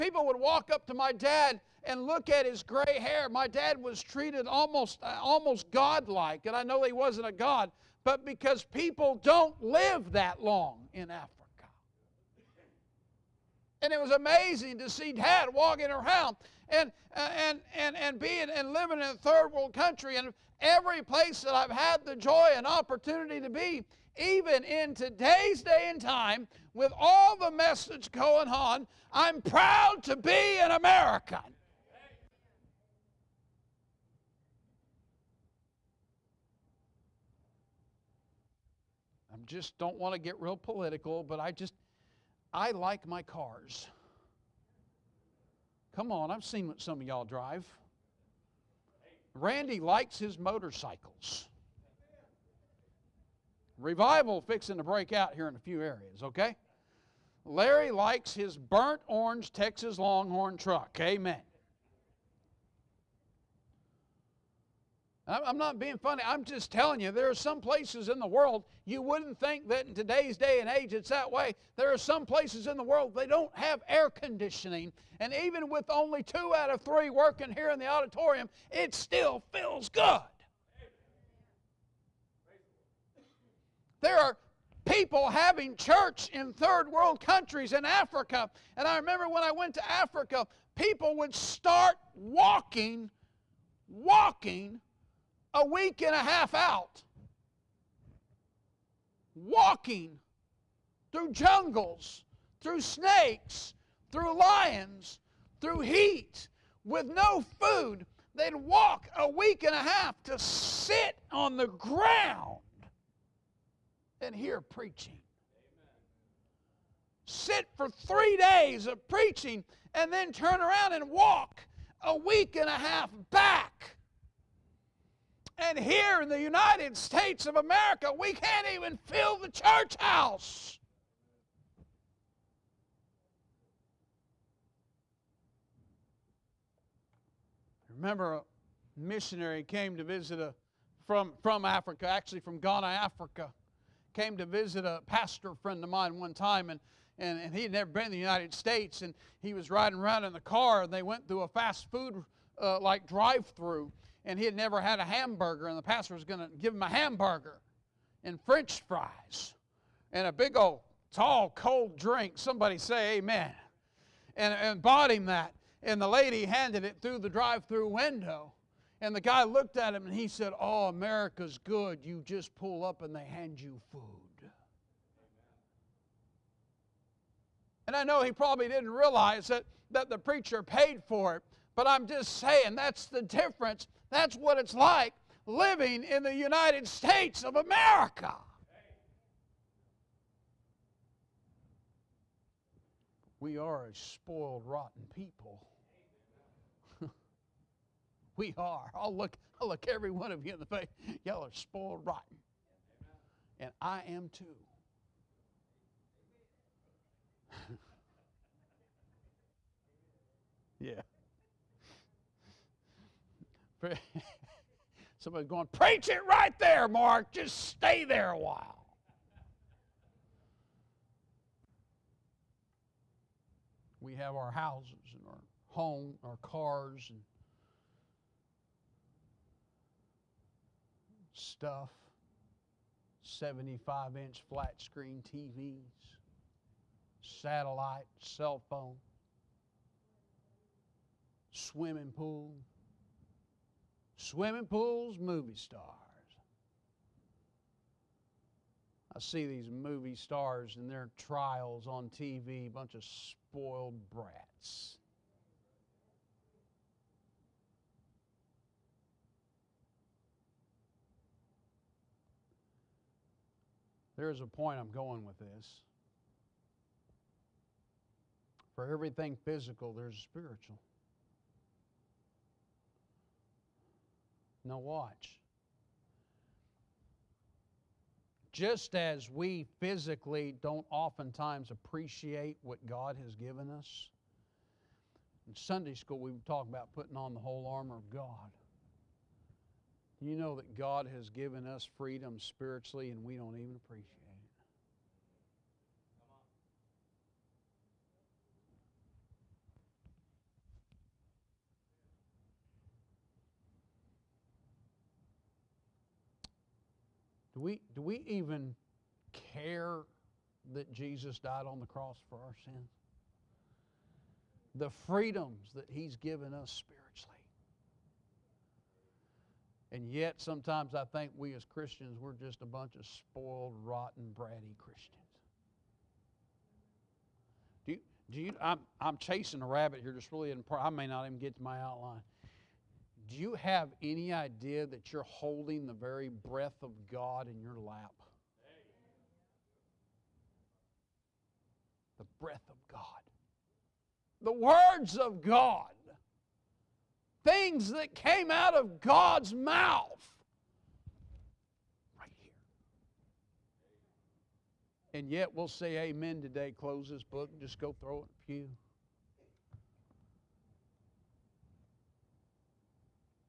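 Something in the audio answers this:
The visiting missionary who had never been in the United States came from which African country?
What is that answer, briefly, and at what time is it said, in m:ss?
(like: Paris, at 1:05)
Ghana, at 2:22.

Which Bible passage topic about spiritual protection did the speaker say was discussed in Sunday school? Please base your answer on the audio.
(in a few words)
The whole armor of God.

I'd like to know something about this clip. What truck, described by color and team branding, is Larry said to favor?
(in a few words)
Burnt orange Texas Longhorn truck.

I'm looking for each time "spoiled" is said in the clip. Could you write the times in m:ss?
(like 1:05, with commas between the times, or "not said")
3:13, 3:21, 4:13, 5:23.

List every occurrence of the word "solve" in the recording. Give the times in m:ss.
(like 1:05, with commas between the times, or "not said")
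not said.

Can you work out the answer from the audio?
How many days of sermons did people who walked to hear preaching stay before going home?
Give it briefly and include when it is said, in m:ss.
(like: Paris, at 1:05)
3 days, at 1:57.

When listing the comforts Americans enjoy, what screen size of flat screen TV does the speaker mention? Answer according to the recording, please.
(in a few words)
75 inch.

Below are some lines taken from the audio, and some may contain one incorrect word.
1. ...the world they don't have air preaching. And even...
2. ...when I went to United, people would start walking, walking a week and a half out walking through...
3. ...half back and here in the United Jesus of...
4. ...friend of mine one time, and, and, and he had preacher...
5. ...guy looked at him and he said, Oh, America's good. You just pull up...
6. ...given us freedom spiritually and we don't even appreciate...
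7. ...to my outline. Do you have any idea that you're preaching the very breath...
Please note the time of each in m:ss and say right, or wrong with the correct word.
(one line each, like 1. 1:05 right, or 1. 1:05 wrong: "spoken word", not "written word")
1. 1:12 wrong: "conditioning", not "preaching"
2. 1:29 wrong: "Africa", not "United"
3. 2:02 wrong: "States", not "Jesus"
4. 2:25 wrong: "never", not "preacher"
5. 2:49 right
6. 4:51 right
7. 5:31 wrong: "holding", not "preaching".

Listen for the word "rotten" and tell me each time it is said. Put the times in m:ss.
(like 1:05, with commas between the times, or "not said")
3:14, 3:22, 5:23.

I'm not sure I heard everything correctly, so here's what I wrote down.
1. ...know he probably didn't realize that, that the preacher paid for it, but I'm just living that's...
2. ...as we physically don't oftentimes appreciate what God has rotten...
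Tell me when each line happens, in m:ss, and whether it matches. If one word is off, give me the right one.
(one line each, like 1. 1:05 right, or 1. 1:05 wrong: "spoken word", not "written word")
1. 2:58 wrong: "saying", not "living"
2. 4:38 wrong: "given", not "rotten".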